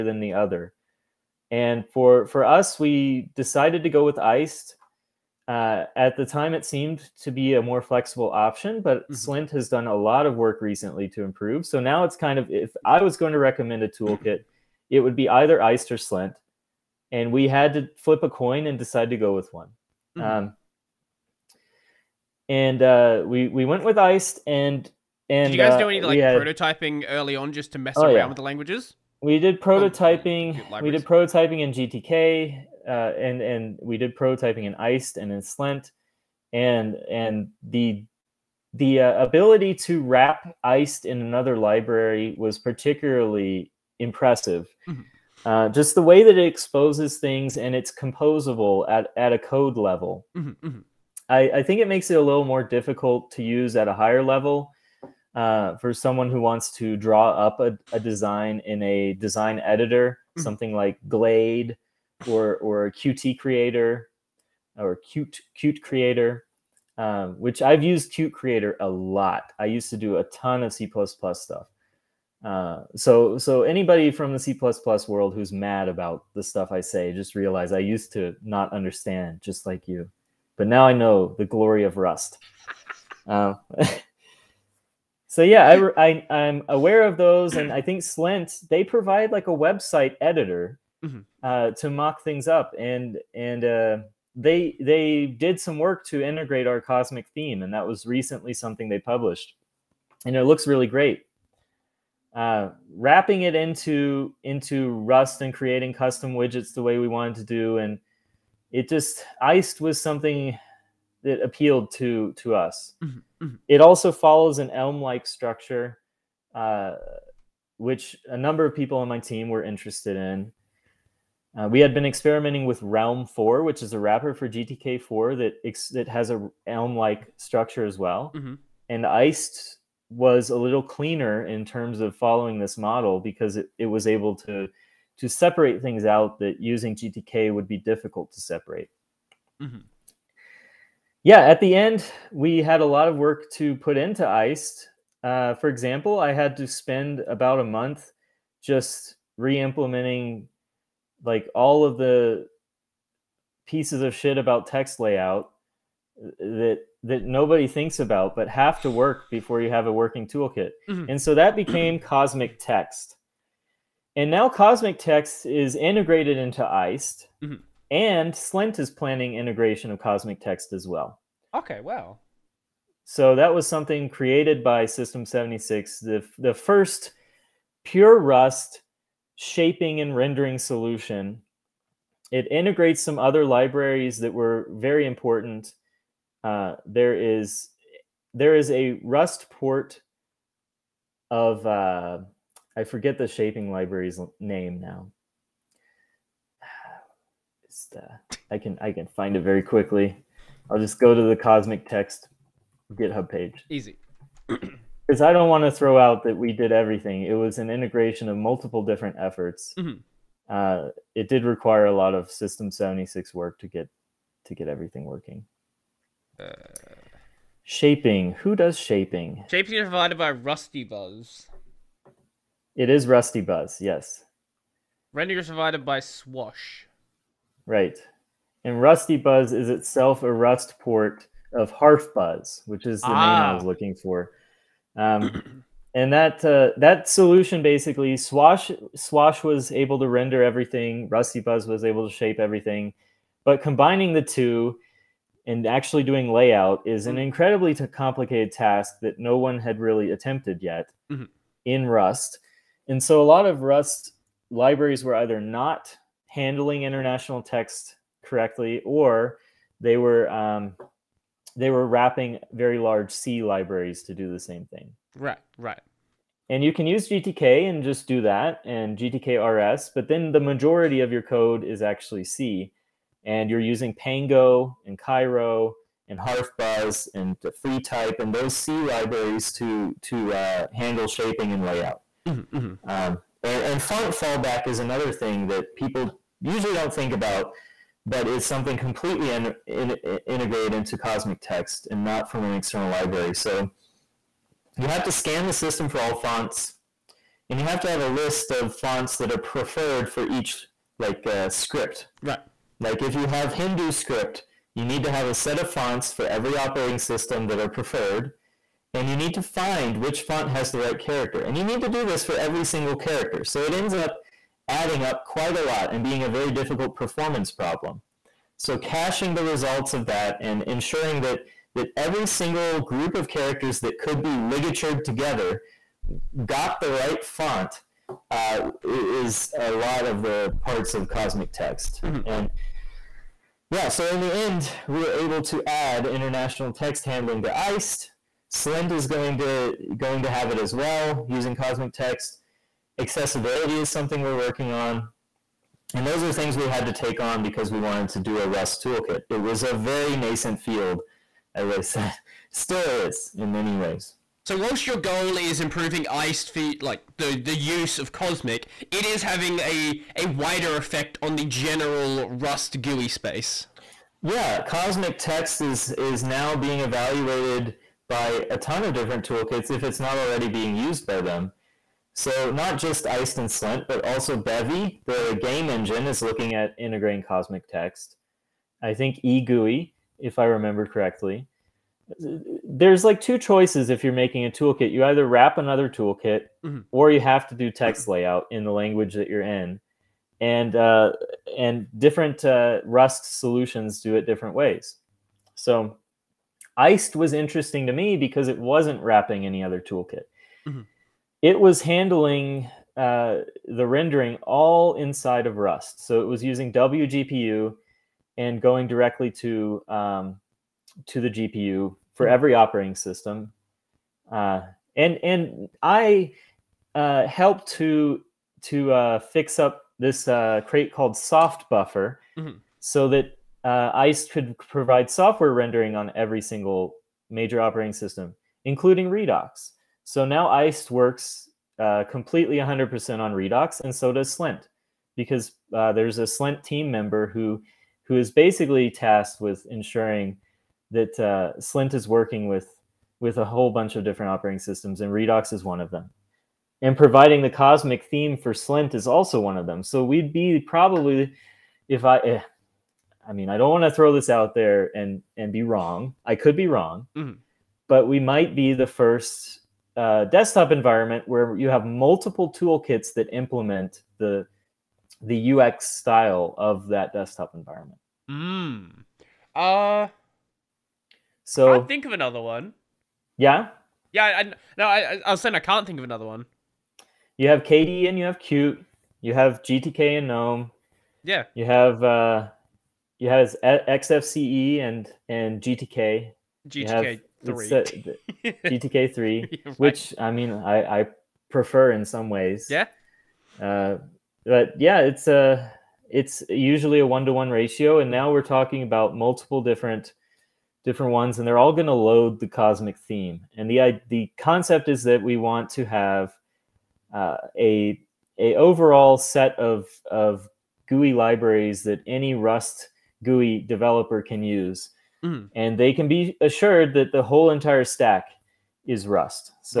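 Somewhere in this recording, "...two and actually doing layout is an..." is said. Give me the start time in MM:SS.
04:04.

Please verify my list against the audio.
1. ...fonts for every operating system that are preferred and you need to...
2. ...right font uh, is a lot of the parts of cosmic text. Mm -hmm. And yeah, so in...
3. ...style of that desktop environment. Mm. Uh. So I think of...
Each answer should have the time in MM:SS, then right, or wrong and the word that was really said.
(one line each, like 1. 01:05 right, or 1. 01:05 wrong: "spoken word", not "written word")
1. 05:05 right
2. 05:26 right
3. 07:45 right.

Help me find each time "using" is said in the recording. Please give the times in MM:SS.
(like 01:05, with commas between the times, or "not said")
02:16, 04:33, 05:41, 06:46.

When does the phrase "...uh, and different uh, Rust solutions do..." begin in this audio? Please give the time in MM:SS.
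06:30.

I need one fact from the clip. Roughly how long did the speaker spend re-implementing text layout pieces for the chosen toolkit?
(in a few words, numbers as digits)
About a month.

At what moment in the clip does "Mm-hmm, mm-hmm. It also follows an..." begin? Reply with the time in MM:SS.
01:53.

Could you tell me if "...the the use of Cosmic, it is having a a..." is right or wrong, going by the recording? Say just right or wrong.
right.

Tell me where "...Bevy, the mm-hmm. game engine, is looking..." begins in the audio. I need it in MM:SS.
06:14.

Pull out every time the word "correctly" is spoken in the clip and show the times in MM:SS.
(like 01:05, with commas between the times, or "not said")
04:18, 06:20.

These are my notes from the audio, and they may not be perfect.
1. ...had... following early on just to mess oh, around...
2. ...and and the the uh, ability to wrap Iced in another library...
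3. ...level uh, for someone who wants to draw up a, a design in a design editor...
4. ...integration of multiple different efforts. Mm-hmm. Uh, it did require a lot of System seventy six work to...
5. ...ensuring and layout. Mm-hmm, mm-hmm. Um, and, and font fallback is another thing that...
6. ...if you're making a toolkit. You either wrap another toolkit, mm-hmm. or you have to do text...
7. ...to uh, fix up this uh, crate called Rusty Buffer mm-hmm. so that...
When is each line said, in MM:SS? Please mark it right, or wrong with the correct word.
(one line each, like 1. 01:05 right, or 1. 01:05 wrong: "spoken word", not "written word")
1. 00:26 wrong: "prototyping", not "following"
2. 00:36 right
3. 00:54 right
4. 03:27 right
5. 04:41 wrong: "shaping", not "ensuring"
6. 06:23 right
7. 06:58 wrong: "Soft", not "Rusty".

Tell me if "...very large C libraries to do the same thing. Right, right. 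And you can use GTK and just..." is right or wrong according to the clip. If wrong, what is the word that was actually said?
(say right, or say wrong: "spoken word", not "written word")
right.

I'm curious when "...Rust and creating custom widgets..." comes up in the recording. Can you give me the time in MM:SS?
01:44.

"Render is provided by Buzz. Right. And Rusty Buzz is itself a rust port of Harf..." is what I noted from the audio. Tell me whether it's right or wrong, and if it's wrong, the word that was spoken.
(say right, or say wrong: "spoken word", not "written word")
wrong: "Swash", not "Buzz".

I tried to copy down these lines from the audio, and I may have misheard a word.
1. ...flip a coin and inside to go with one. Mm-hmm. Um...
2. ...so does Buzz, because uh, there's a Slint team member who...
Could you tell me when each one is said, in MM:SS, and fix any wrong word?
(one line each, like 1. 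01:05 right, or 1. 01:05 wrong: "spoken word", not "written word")
1. 00:17 wrong: "decide", not "inside"
2. 07:13 wrong: "Slint", not "Buzz".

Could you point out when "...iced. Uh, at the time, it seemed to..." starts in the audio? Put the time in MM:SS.
00:04.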